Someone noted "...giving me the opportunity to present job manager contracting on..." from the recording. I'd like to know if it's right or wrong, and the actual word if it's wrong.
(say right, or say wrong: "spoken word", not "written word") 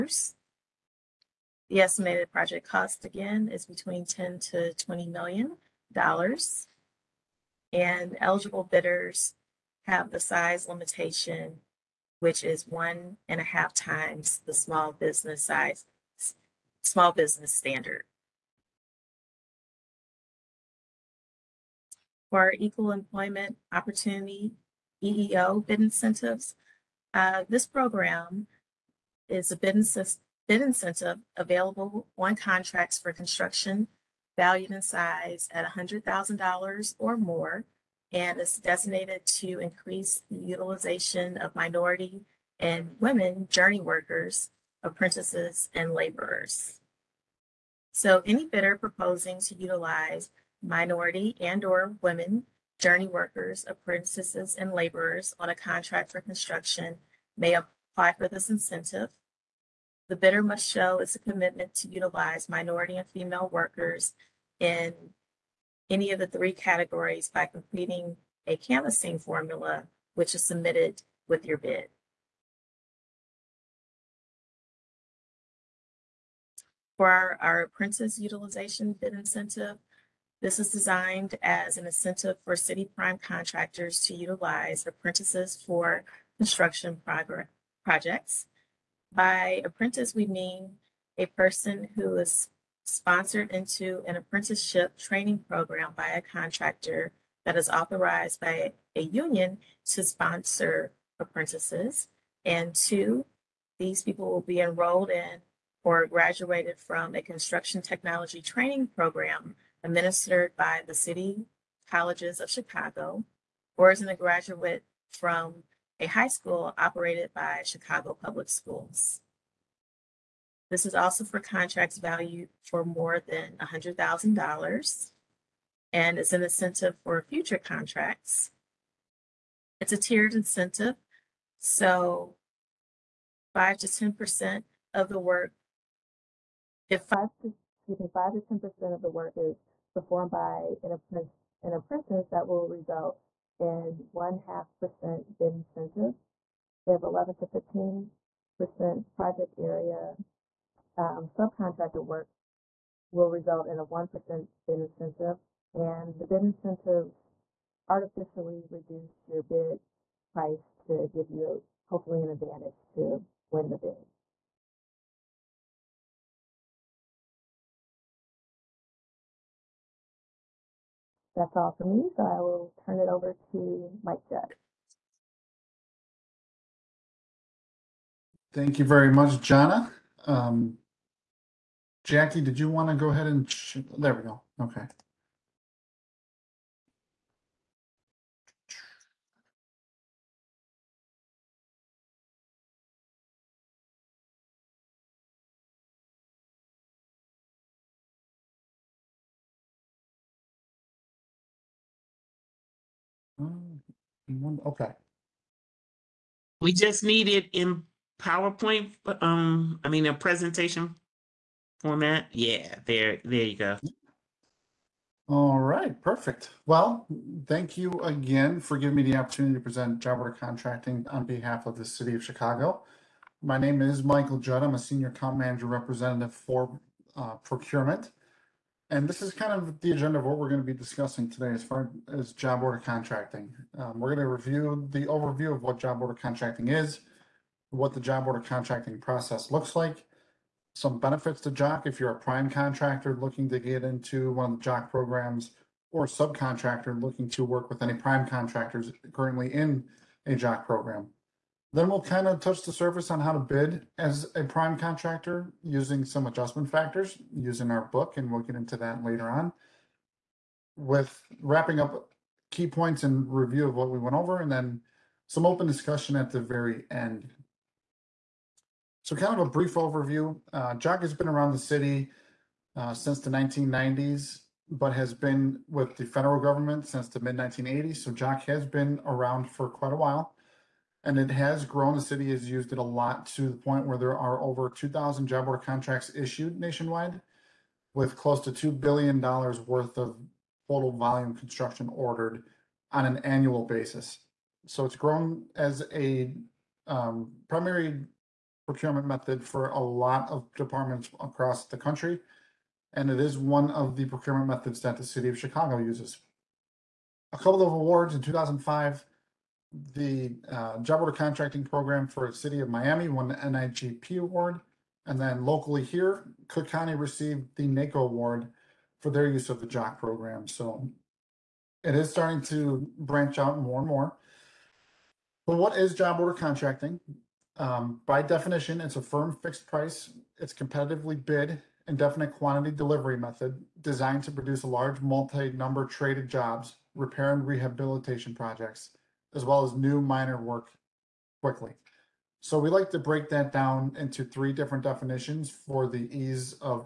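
wrong: "order", not "manager".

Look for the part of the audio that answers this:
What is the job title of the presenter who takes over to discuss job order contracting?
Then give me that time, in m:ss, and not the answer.
3:44.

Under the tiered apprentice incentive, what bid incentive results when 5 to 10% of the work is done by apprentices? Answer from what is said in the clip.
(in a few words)
one half percent.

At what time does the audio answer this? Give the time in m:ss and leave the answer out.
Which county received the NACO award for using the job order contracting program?
5:16.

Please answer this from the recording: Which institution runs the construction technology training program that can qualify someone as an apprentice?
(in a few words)
City Colleges of Chicago.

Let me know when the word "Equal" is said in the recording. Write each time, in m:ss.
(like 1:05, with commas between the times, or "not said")
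0:22.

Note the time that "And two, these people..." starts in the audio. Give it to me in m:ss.
1:42.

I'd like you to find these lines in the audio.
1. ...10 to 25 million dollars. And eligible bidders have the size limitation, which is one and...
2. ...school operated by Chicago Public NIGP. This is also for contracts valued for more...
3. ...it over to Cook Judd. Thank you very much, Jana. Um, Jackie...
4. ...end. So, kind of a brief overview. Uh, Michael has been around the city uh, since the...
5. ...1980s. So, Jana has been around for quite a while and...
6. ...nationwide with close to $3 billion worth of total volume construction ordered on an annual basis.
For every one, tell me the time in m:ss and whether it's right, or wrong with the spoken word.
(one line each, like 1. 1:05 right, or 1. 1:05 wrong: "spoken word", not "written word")
1. 0:04 wrong: "20", not "25"
2. 1:56 wrong: "Schools", not "NIGP"
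3. 2:52 wrong: "Mike", not "Cook"
4. 4:26 wrong: "JOC", not "Michael"
5. 4:37 wrong: "JOC", not "Jana"
6. 4:46 wrong: "2", not "3".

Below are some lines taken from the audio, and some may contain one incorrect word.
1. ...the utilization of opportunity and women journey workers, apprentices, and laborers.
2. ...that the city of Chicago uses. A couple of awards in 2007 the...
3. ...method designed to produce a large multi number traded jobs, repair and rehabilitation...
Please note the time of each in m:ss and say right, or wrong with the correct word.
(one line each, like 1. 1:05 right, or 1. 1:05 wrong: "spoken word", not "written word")
1. 0:40 wrong: "minority", not "opportunity"
2. 5:04 wrong: "2005", not "2007"
3. 5:33 right.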